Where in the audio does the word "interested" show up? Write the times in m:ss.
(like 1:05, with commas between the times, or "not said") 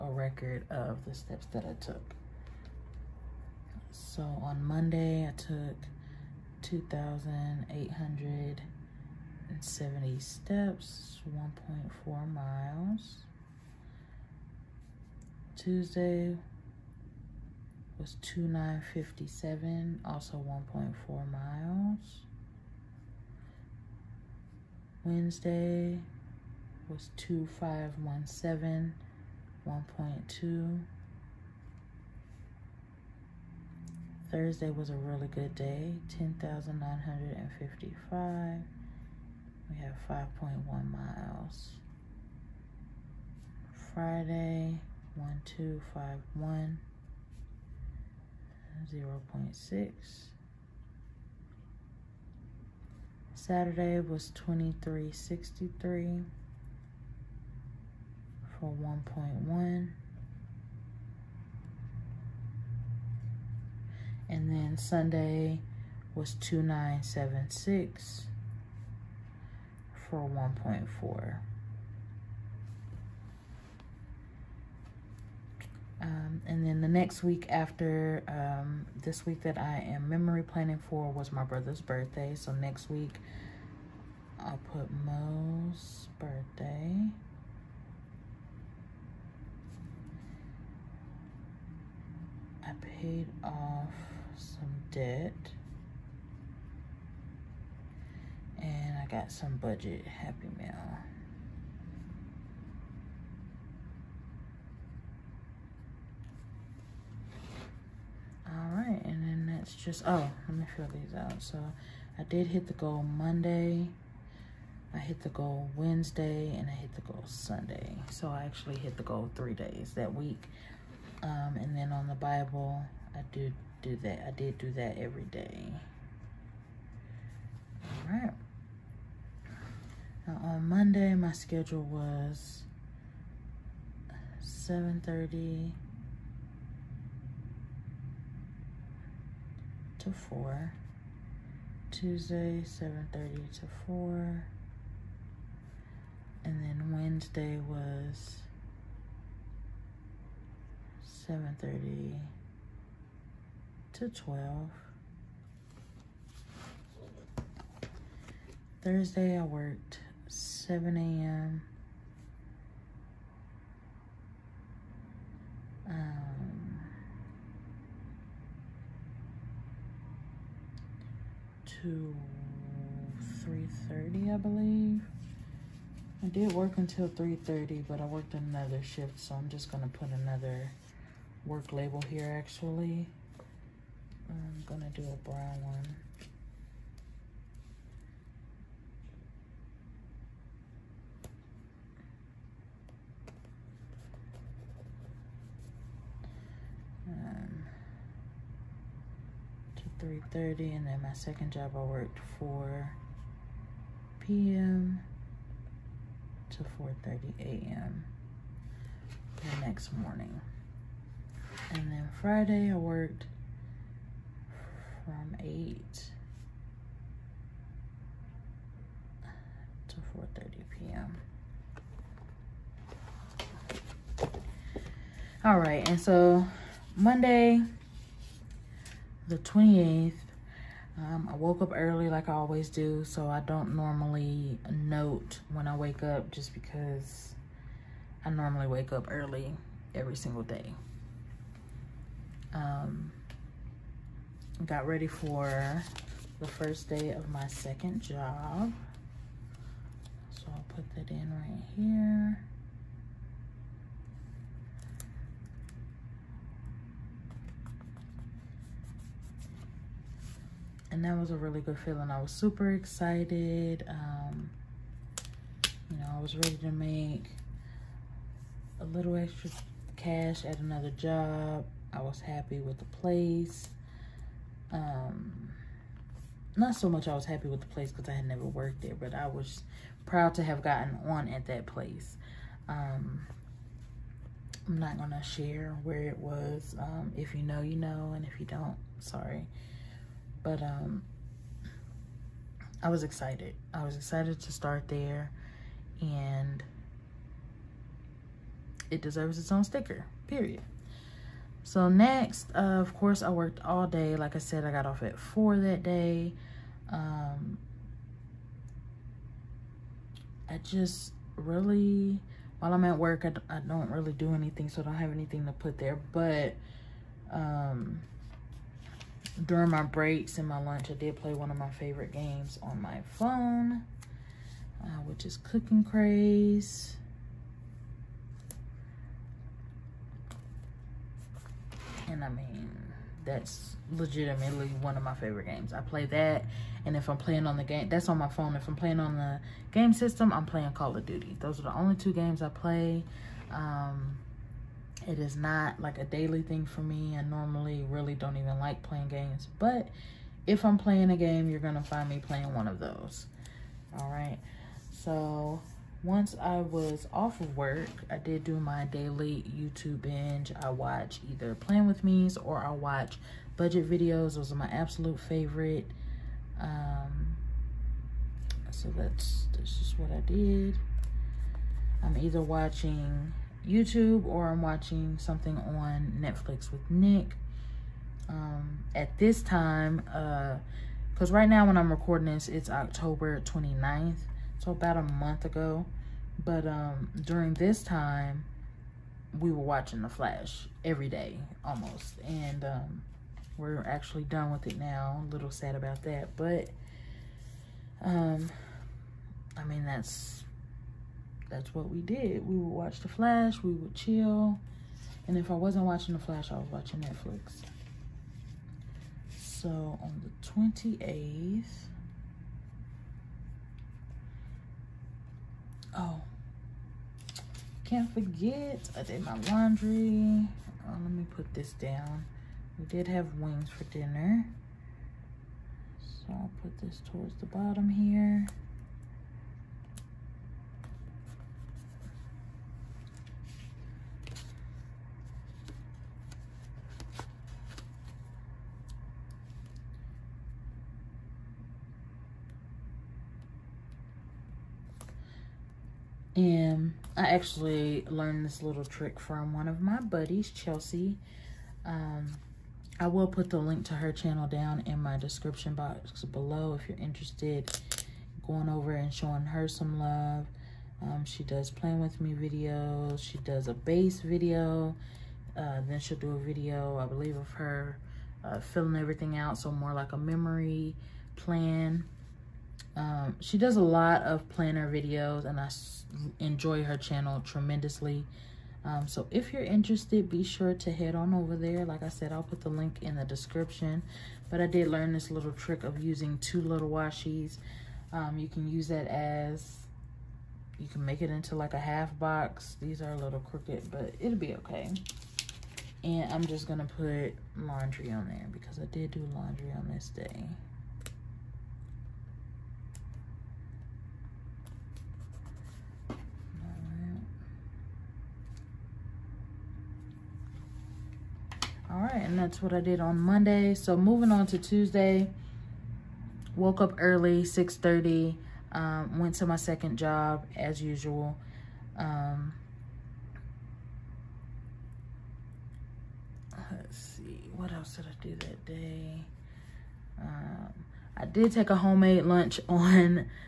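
7:36, 7:59.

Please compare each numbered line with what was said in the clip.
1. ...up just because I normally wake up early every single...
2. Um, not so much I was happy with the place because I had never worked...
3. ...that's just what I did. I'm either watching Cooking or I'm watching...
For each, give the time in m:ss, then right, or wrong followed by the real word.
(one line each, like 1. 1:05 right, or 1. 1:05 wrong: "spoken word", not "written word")
1. 3:56 right
2. 4:34 right
3. 6:09 wrong: "YouTube", not "Cooking".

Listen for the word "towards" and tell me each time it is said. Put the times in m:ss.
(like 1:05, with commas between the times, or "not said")
7:07.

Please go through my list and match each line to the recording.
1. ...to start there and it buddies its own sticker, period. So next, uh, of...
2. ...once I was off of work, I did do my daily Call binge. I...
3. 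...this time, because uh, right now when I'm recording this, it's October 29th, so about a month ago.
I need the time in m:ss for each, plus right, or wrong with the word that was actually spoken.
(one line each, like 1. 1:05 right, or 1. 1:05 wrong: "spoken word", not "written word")
1. 4:54 wrong: "deserves", not "buddies"
2. 5:56 wrong: "YouTube", not "Call"
3. 6:19 right.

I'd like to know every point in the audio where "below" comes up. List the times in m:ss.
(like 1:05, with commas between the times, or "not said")
7:36.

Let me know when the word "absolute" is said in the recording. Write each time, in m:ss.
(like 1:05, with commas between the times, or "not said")
6:04.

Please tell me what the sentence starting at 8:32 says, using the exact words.
right, and that's what I did on Monday.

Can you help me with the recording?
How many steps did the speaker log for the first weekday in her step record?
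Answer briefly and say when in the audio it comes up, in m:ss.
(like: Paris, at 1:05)
2,870, at 0:06.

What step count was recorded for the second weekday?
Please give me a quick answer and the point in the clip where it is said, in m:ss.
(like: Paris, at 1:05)
2,957, at 0:18.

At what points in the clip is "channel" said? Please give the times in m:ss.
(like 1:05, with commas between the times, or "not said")
7:34, 7:56.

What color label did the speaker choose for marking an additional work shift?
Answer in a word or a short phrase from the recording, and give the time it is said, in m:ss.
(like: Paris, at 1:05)
Brown, at 3:05.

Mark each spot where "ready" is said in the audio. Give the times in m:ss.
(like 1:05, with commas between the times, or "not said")
4:04, 4:26.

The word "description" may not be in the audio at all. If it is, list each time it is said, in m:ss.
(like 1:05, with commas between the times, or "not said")
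7:35, 8:03.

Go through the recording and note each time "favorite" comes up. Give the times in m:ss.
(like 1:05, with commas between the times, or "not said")
5:21, 5:35, 6:05.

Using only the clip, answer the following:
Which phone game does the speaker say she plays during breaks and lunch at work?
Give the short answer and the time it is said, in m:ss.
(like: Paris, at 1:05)
Cooking Craze, at 5:25.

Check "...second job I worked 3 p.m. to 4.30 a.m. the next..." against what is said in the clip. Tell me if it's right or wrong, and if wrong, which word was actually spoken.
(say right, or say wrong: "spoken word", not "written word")
wrong: "4", not "3".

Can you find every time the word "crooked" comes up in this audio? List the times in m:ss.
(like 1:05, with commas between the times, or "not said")
8:13.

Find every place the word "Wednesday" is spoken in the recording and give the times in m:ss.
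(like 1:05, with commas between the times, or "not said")
1:55, 2:26.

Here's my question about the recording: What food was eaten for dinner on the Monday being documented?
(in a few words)
Wings.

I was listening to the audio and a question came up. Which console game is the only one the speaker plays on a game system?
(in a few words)
Call of Duty.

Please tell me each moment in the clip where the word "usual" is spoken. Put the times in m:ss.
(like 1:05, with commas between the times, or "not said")
8:40.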